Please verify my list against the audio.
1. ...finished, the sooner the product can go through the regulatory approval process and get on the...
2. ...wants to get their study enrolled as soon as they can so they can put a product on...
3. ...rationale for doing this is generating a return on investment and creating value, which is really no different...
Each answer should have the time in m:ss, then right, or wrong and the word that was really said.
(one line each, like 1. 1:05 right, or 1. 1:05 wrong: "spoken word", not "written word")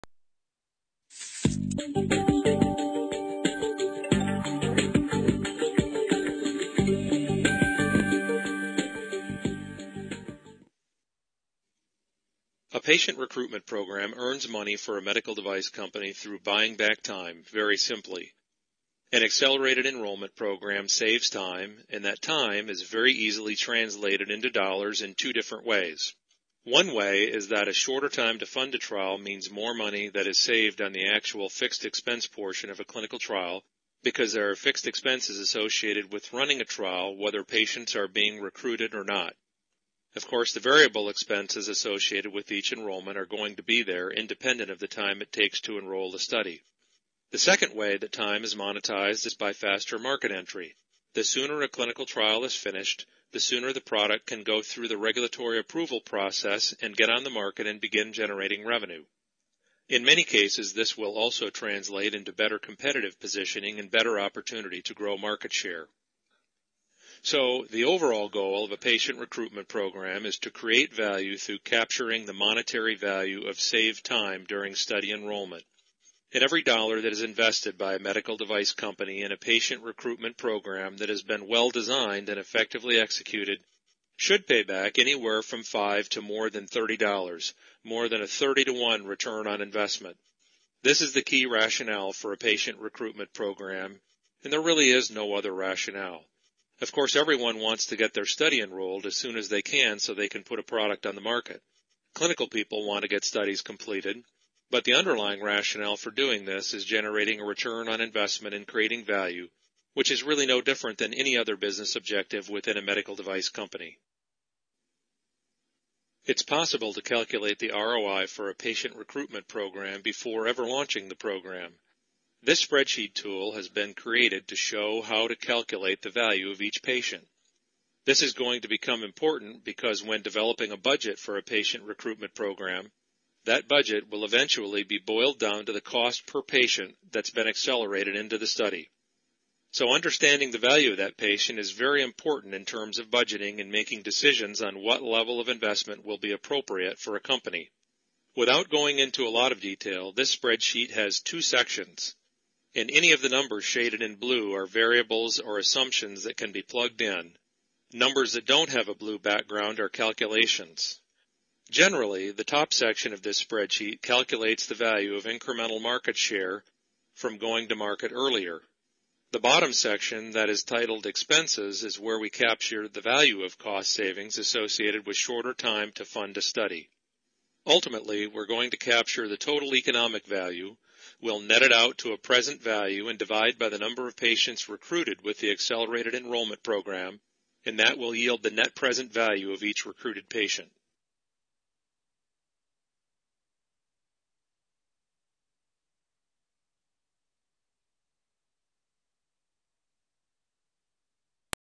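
1. 0:52 right
2. 1:37 right
3. 1:45 right.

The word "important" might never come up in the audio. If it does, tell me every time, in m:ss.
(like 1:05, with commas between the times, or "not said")
2:09, 2:22.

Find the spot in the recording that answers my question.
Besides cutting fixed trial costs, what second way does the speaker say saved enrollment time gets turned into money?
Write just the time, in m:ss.
0:49.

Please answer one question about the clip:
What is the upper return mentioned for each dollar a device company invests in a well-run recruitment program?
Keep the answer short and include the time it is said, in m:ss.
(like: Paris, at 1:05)
more than $30, at 1:26.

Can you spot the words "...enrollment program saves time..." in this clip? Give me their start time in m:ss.
0:19.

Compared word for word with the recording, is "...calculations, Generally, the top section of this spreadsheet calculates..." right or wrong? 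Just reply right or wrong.
right.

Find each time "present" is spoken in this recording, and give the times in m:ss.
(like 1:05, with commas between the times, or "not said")
3:02, 3:08.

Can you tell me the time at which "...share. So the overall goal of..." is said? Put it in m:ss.
1:05.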